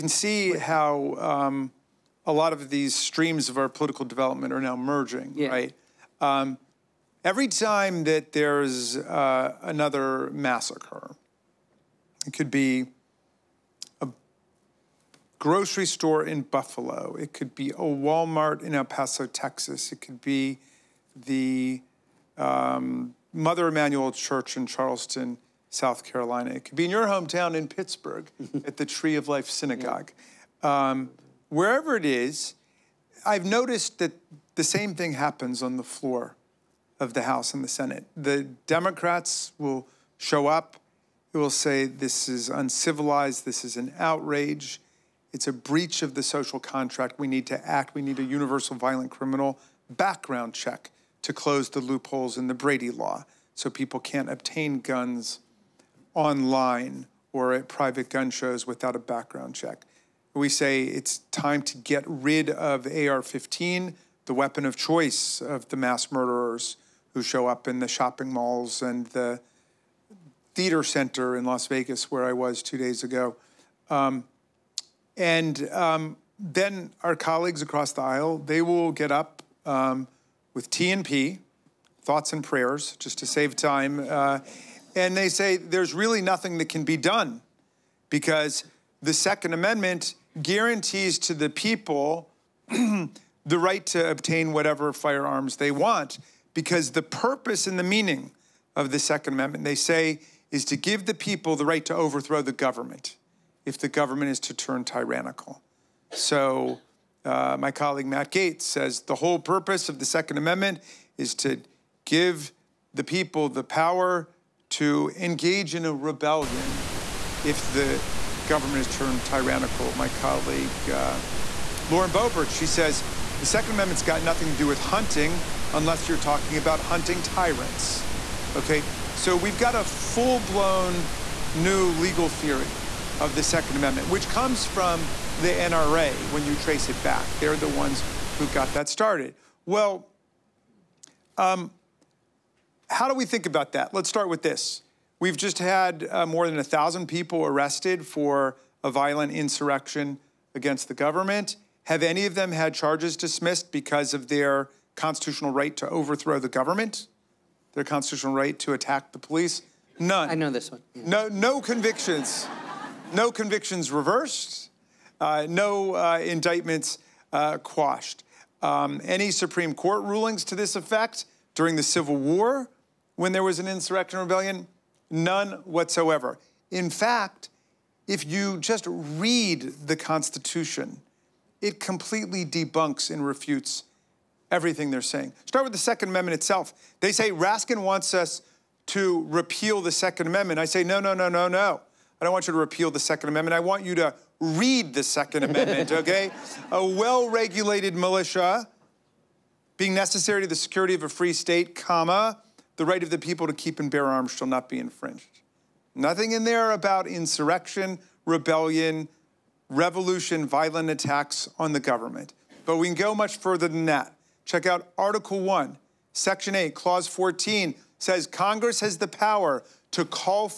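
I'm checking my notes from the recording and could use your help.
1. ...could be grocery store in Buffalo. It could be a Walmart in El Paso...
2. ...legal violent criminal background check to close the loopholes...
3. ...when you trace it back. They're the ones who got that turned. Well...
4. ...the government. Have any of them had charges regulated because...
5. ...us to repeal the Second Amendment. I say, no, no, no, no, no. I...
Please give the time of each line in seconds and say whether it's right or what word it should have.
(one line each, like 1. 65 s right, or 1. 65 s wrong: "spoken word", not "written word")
1. 12 s right
2. 48 s wrong: "universal", not "legal"
3. 136 s wrong: "started", not "turned"
4. 150 s wrong: "dismissed", not "regulated"
5. 188 s right.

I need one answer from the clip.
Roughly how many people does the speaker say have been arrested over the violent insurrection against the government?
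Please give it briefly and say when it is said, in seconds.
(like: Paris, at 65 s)
more than 1,000, at 146 s.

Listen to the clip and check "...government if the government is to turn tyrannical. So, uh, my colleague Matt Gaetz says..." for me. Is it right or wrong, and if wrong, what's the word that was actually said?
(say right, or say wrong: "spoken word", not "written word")
right.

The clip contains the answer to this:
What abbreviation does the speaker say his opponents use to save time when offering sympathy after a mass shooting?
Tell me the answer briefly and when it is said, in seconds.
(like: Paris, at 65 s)
TNP, at 80 s.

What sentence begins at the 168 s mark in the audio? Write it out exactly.
Um, any Supreme Court rulings to this effect during the Civil War when there was an insurrection rebellion?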